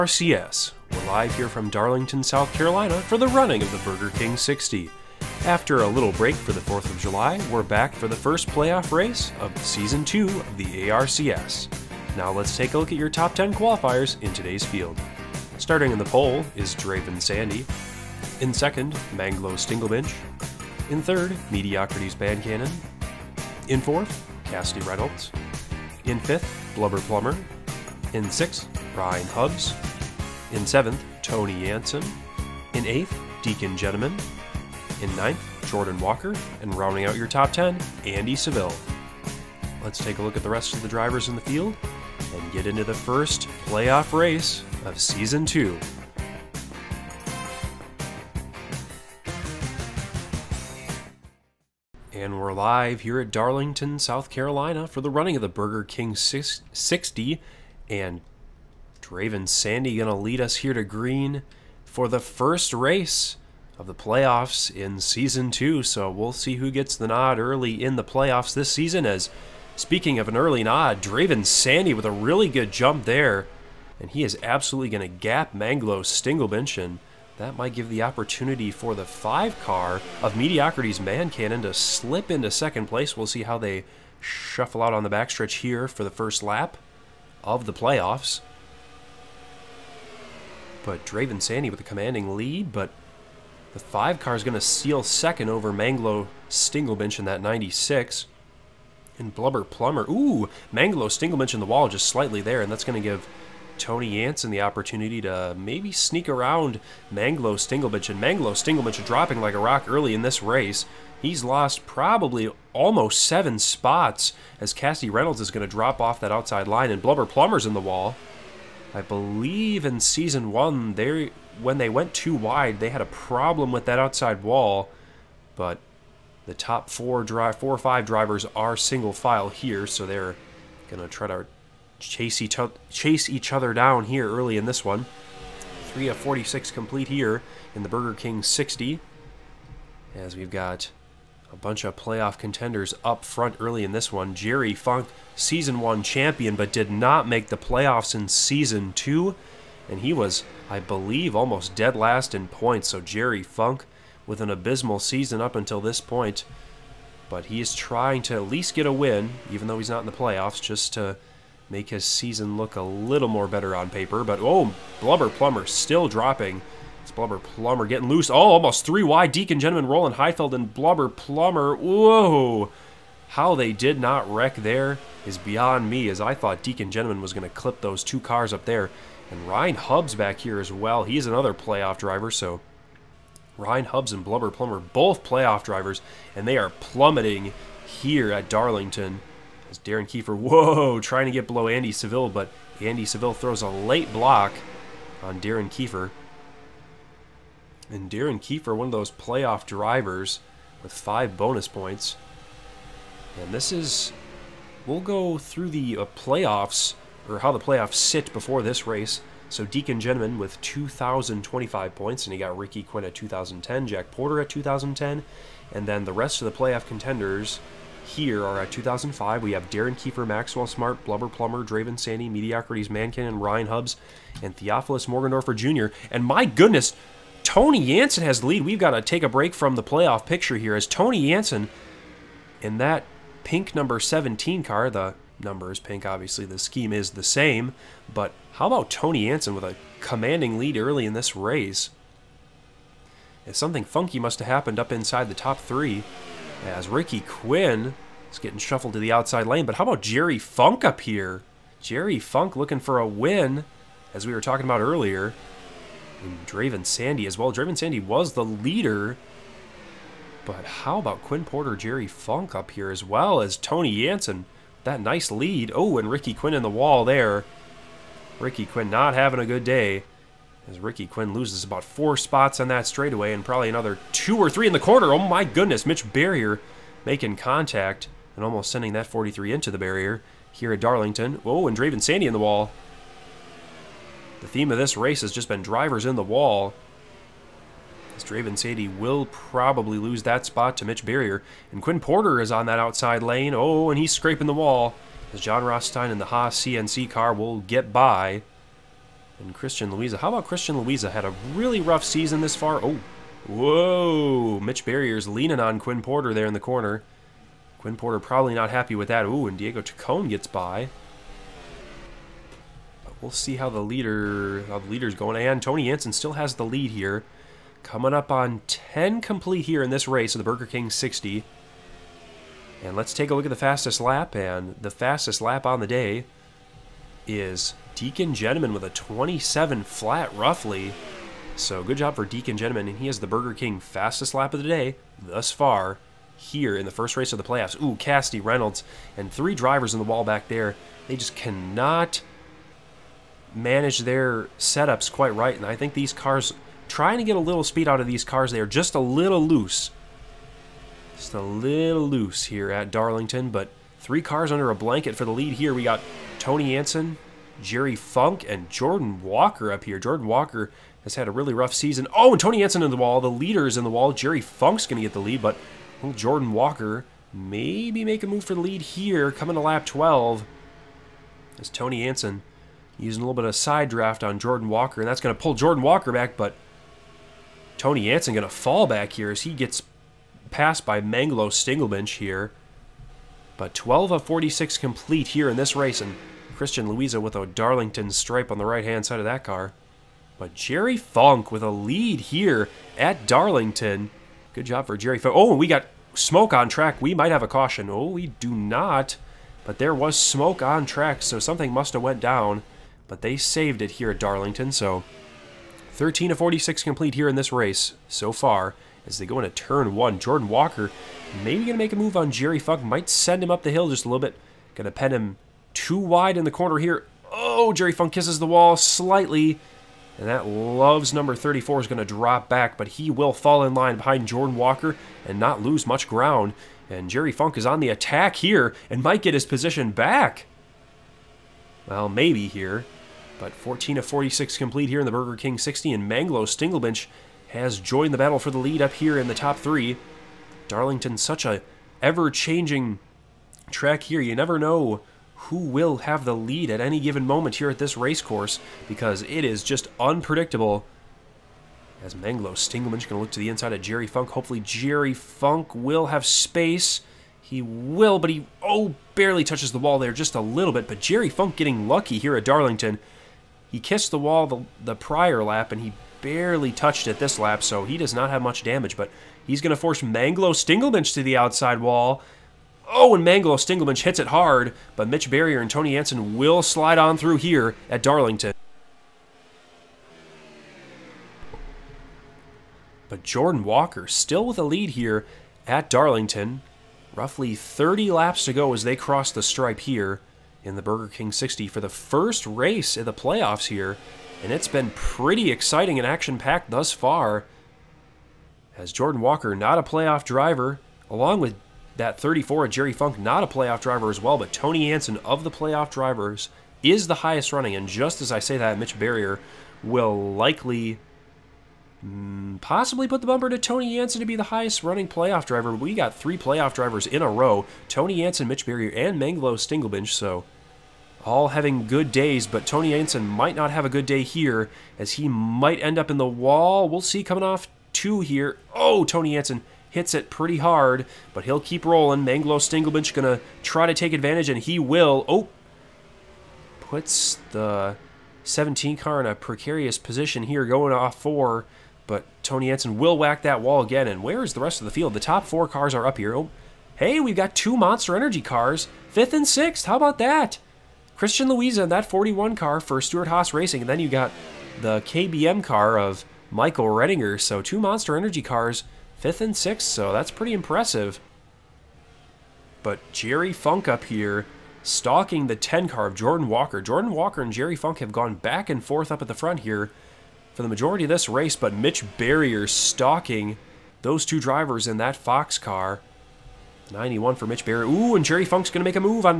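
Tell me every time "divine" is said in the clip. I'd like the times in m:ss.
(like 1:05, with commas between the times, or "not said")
not said.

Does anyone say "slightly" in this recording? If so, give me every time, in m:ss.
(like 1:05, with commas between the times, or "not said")
1:42, 6:58.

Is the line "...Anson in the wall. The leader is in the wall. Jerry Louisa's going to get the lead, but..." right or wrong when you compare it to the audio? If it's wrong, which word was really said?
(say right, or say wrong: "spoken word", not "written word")
wrong: "Funk", not "Louisa".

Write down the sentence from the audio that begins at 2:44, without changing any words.
But, oh, Blubber Plumber still dropping it's Blubber Plumber getting loose.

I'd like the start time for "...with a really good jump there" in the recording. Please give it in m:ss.
1:11.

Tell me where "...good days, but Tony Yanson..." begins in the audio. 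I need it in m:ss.
8:41.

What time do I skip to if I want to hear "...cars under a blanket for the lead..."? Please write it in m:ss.
5:54.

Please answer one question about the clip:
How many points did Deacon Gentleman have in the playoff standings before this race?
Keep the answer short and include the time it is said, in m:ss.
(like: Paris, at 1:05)
2,025, at 3:30.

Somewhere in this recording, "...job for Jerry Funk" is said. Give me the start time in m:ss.
6:34.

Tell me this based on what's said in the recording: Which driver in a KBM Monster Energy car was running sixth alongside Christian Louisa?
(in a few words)
Michael Redinger.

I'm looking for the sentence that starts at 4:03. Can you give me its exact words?
And something funky must have happened up inside the top three as Ricky Quinn is getting shuffled to the outside lane.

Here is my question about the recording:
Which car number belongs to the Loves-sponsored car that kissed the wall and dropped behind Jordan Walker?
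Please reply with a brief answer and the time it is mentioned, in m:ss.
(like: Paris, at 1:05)
34, at 7:00.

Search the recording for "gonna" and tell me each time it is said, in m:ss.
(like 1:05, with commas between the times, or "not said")
2:10, 8:53.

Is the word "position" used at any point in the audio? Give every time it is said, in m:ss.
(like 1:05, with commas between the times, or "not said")
7:09, 8:59.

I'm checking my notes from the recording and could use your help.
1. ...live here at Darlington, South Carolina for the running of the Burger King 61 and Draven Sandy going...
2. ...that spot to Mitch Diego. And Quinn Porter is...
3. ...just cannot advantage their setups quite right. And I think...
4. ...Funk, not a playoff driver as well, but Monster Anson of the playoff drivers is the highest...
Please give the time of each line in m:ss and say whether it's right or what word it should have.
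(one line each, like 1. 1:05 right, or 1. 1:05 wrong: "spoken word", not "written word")
1. 0:52 wrong: "60", not "61"
2. 4:50 wrong: "Barrier", not "Diego"
3. 5:41 wrong: "manage", not "advantage"
4. 8:22 wrong: "Tony", not "Monster".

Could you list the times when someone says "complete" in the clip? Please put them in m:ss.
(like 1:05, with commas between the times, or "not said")
2:16, 5:19, 6:24, 6:46, 7:14.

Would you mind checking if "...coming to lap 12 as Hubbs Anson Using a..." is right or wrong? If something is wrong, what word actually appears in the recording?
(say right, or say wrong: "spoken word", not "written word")
wrong: "Tony", not "Hubbs".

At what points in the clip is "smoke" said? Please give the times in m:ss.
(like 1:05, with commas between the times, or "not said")
6:36, 6:40.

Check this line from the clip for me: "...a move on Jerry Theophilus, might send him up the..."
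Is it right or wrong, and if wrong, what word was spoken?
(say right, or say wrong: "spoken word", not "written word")
wrong: "Funk", not "Theophilus".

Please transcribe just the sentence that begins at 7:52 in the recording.
Oh, and Manglo Stinglebench hits it hard, but Mitch Barrier and Tony Anson will slide on through here at Darlington.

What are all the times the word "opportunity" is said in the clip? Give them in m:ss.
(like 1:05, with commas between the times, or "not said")
1:18, 1:44.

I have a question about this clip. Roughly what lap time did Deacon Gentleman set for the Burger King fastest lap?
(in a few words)
27 flat.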